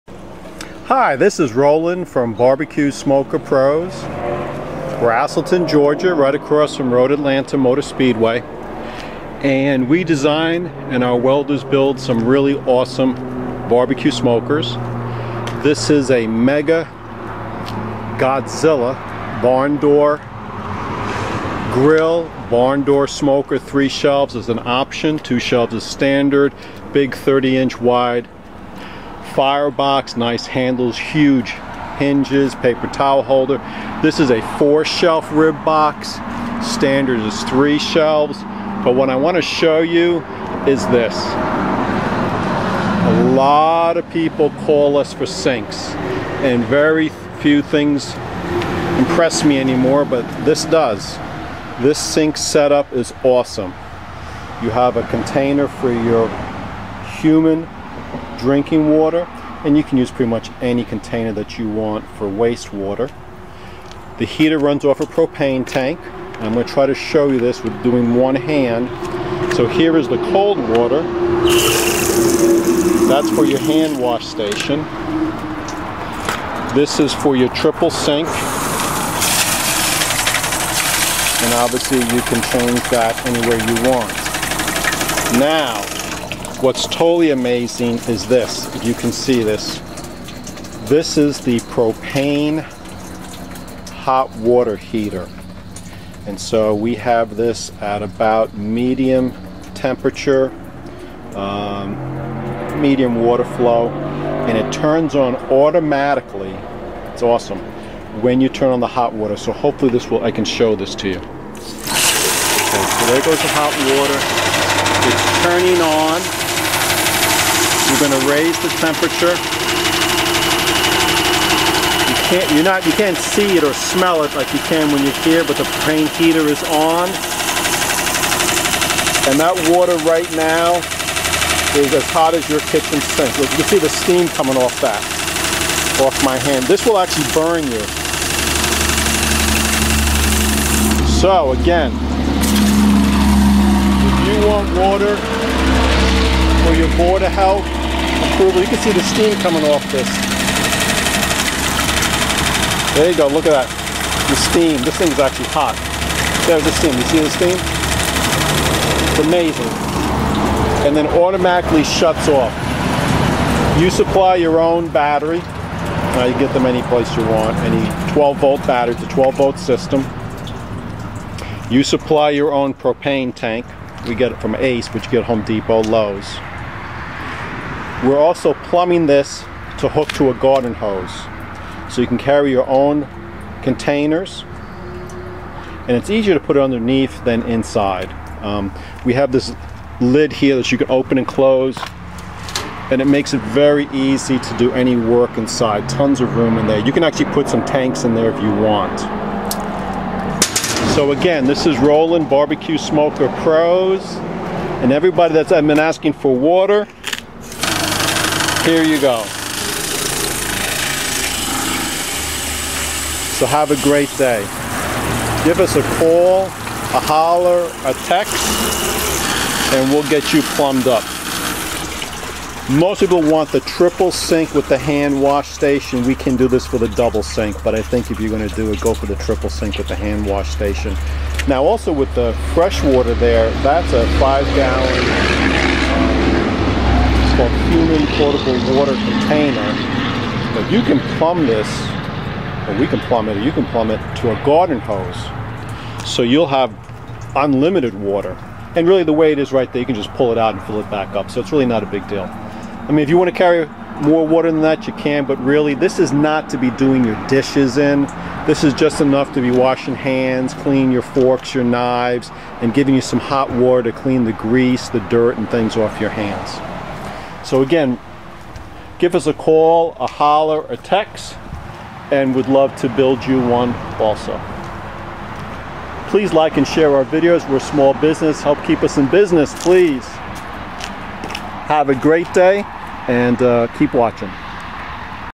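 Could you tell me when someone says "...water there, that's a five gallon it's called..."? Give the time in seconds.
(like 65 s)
232 s.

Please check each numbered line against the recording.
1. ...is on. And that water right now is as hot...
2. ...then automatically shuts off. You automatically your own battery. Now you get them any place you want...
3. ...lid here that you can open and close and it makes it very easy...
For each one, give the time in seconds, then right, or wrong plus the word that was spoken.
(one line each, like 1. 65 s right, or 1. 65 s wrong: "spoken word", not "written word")
1. 126 s right
2. 160 s wrong: "supply", not "automatically"
3. 189 s right.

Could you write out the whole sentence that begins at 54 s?
You have a container for your human drinking water and you can use pretty much any container that you want for wastewater.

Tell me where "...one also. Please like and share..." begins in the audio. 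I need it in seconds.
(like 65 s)
273 s.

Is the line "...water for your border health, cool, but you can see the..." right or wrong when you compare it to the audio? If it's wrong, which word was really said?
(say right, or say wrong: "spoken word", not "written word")
right.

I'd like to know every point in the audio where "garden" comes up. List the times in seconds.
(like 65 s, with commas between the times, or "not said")
180 s, 244 s.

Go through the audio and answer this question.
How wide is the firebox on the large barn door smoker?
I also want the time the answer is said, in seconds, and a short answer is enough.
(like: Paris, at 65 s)
30 inches, at 27 s.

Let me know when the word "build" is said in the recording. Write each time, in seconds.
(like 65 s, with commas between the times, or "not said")
11 s, 272 s.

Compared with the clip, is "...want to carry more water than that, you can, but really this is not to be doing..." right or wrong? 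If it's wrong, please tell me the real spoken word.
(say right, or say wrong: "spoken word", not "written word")
right.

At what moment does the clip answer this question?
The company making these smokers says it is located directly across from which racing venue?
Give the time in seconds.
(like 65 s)
6 s.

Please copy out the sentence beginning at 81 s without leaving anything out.
And obviously you can change that any way you want.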